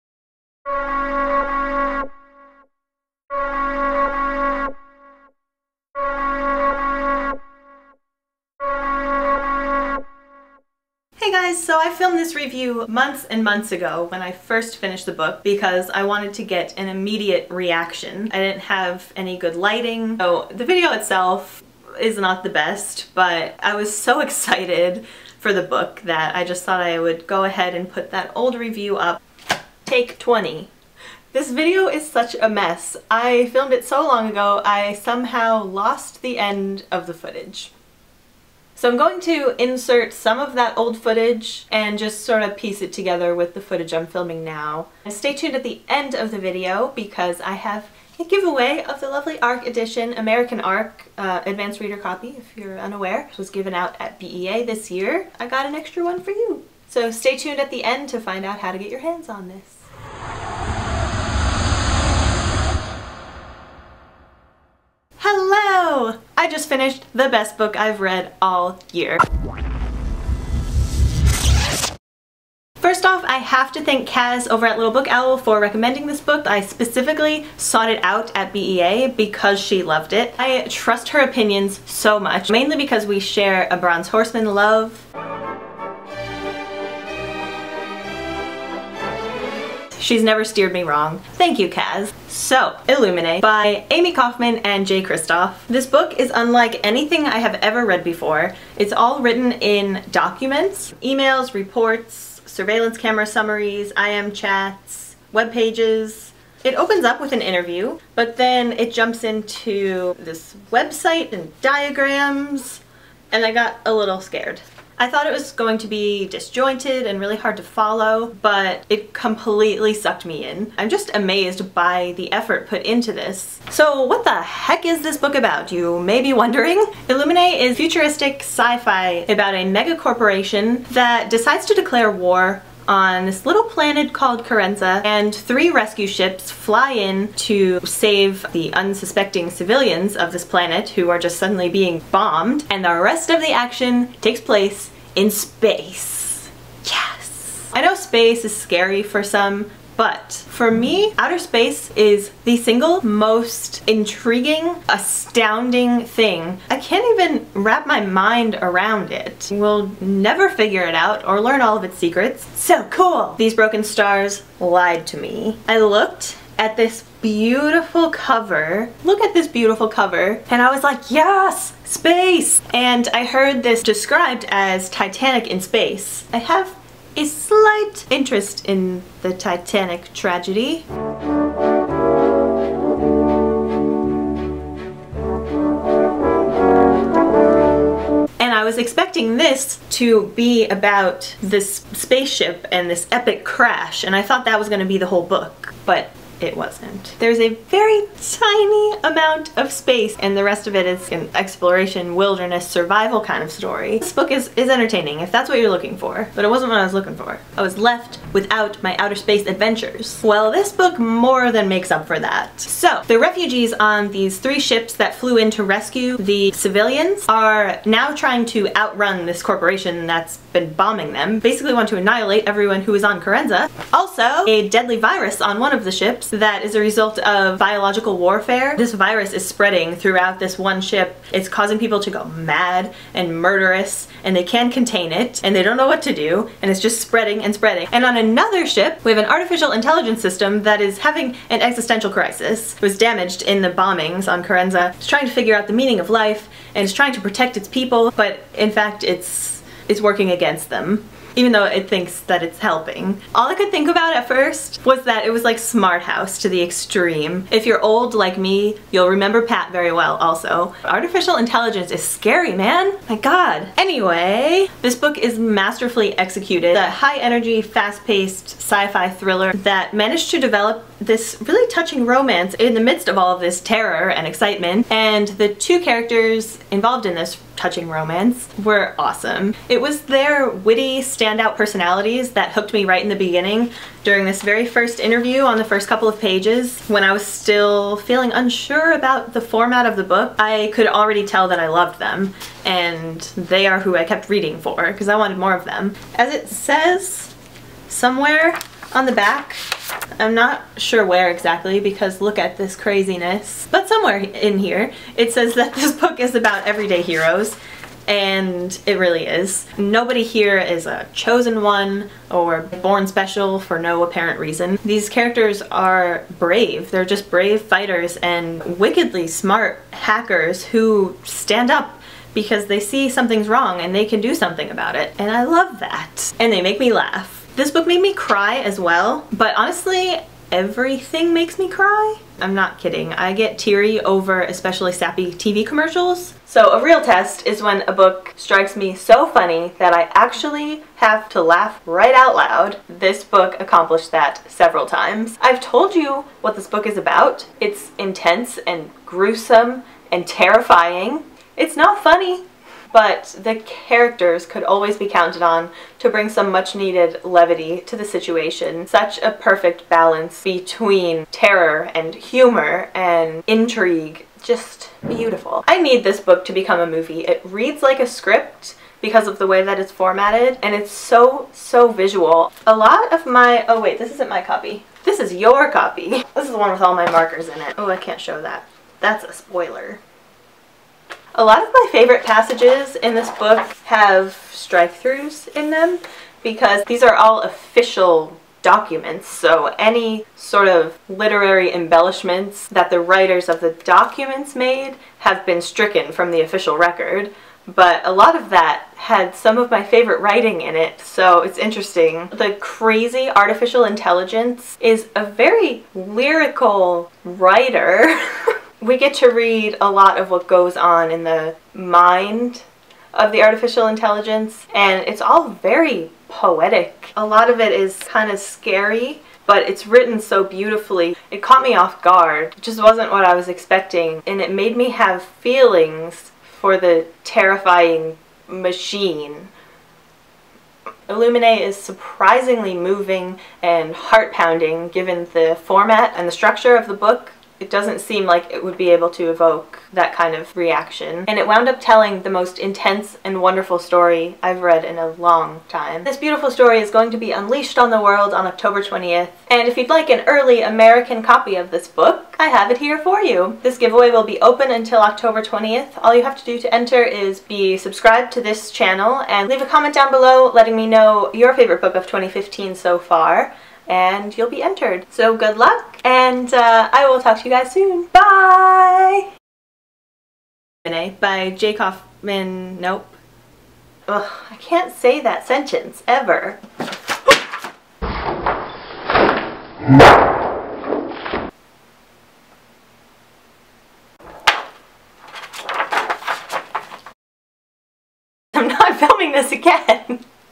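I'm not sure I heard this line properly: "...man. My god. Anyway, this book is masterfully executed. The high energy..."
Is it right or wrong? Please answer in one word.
right.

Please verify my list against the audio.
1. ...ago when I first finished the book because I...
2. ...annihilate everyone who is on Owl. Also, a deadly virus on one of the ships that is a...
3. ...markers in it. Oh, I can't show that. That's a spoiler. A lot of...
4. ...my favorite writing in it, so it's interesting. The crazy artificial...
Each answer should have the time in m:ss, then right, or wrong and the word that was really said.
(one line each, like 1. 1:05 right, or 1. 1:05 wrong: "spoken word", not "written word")
1. 0:13 right
2. 3:41 wrong: "Kerenza", not "Owl"
3. 6:17 right
4. 6:39 right.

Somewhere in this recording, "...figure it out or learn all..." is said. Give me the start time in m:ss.
2:40.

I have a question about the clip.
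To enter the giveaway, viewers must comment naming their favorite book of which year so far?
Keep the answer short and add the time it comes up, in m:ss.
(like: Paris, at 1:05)
2015, at 7:42.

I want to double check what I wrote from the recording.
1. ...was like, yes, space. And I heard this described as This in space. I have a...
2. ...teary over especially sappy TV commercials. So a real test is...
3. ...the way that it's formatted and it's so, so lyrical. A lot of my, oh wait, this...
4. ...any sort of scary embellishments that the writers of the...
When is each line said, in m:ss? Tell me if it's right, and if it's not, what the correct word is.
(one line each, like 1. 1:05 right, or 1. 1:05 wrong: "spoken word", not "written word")
1. 2:50 wrong: "Titanic", not "This"
2. 5:33 right
3. 6:09 wrong: "visual", not "lyrical"
4. 6:29 wrong: "literary", not "scary".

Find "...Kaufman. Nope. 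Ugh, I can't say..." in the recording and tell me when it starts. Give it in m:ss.
7:51.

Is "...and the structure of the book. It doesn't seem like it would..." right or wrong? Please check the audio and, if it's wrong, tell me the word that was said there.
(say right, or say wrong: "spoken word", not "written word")
right.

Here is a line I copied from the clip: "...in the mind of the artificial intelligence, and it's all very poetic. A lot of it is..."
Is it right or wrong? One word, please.
right.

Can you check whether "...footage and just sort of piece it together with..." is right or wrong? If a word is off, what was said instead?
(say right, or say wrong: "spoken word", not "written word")
right.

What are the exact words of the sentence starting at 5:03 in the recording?
But somewhere in here it says that this book is about everyday heroes and it really is.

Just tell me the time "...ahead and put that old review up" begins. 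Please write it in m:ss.
0:27.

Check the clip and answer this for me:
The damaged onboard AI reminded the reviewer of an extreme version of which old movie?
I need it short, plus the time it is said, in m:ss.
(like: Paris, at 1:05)
Smart House, at 4:15.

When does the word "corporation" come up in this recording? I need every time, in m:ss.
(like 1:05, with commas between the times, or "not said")
2:09, 3:39.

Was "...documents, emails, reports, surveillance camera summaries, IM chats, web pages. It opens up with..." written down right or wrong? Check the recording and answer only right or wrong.
right.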